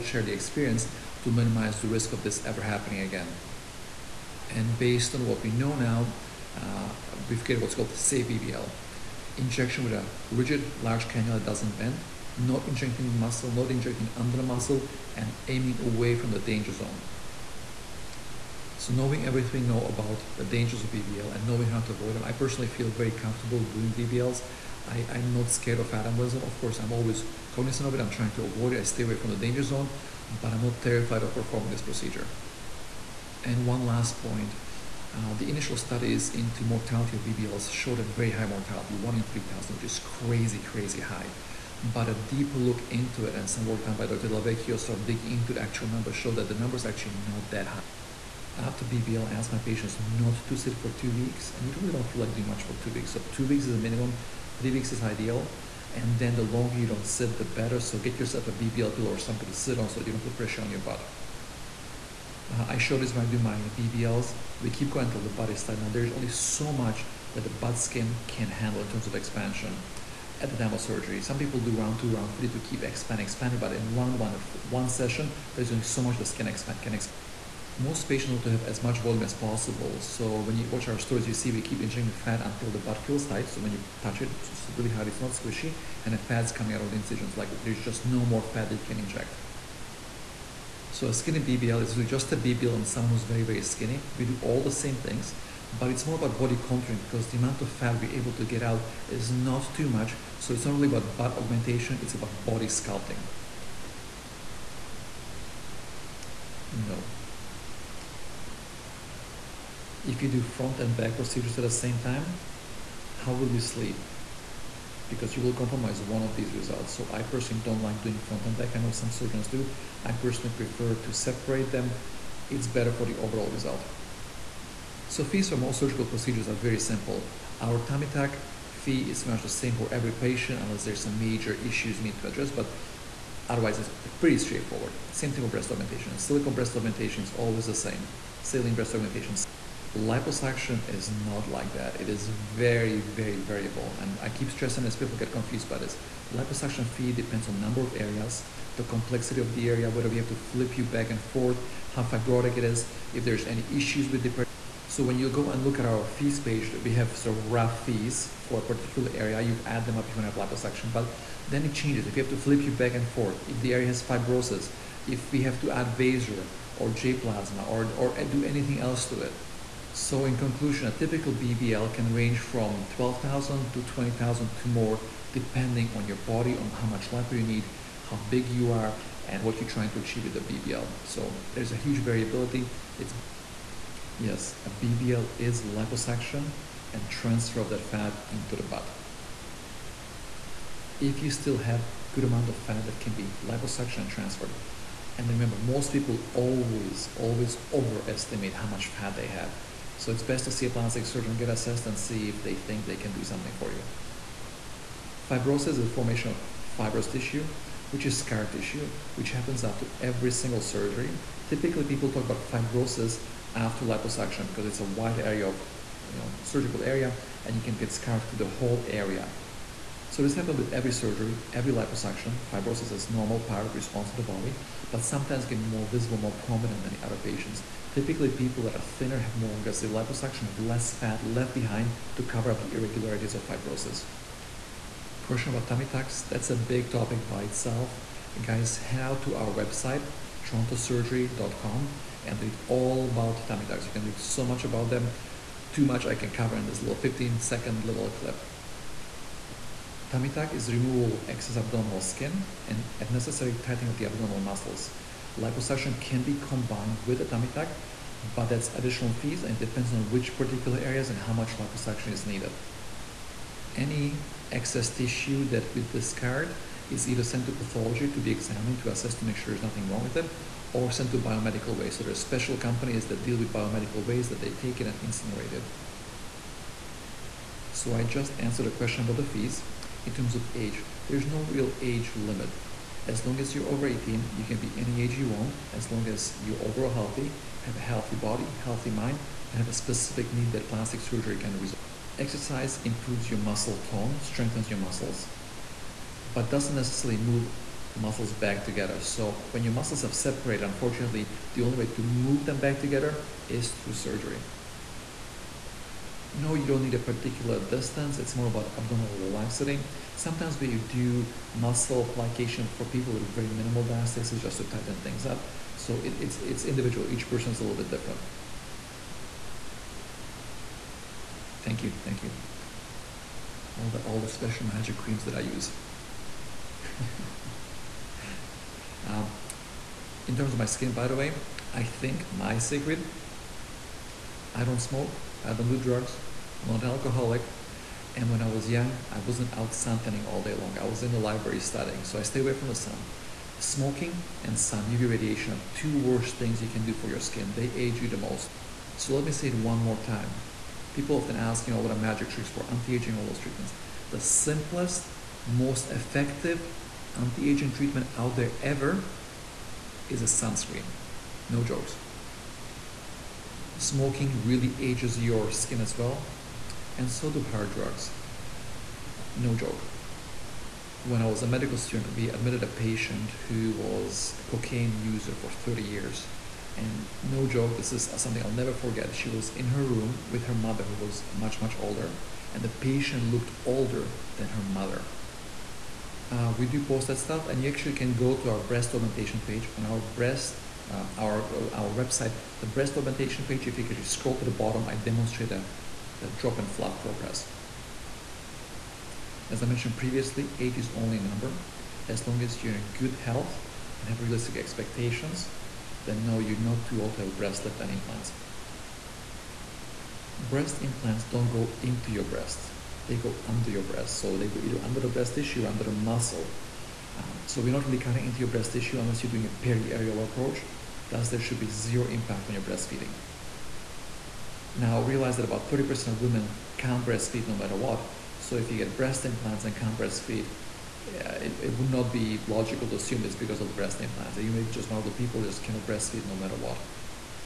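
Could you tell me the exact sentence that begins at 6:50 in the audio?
Breast implants don't go into your breast, they go under your breast.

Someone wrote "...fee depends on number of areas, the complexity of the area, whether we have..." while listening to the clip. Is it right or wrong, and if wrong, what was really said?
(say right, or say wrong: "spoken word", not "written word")
right.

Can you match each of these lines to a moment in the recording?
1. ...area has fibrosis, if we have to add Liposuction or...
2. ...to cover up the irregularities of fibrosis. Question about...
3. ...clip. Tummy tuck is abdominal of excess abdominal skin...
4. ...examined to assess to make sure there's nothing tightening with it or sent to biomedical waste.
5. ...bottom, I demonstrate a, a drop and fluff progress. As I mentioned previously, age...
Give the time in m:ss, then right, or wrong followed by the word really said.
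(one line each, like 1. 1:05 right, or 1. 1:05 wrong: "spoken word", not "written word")
1. 2:43 wrong: "Vaser", not "Liposuction"
2. 3:52 right
3. 4:08 wrong: "removal", not "abdominal"
4. 4:28 wrong: "wrong", not "tightening"
5. 6:34 right.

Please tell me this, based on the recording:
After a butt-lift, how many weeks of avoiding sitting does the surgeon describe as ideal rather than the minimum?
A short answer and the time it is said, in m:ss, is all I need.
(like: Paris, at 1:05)
3 weeks, at 0:54.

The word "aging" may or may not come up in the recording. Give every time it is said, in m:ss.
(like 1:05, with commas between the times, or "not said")
5:52, 5:57.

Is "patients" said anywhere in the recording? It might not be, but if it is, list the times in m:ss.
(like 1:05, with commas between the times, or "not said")
0:49, 1:18, 2:10, 3:47, 6:12, 6:22.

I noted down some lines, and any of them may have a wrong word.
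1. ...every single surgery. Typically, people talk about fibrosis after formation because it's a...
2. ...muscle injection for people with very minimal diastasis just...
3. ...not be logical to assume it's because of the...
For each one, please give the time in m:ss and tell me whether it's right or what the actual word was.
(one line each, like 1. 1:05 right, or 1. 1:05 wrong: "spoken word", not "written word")
1. 3:30 wrong: "liposuction", not "formation"
2. 5:11 wrong: "plication", not "injection"
3. 7:11 right.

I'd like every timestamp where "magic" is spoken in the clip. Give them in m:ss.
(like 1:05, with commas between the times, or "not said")
5:24, 5:51.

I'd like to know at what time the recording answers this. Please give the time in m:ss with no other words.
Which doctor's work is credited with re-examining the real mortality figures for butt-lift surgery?
0:44.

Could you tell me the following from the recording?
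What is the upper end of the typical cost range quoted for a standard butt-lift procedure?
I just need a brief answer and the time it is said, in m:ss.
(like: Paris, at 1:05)
20,000, at 2:53.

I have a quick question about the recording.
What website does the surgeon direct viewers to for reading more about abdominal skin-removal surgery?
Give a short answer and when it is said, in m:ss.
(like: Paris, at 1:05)
torontosurgery.com, at 4:00.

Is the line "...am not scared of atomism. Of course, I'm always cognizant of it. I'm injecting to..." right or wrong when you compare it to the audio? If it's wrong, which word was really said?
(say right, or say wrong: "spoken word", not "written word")
wrong: "trying", not "injecting".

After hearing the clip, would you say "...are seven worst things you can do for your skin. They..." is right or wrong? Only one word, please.
wrong.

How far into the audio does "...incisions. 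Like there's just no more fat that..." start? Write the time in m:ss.
1:26.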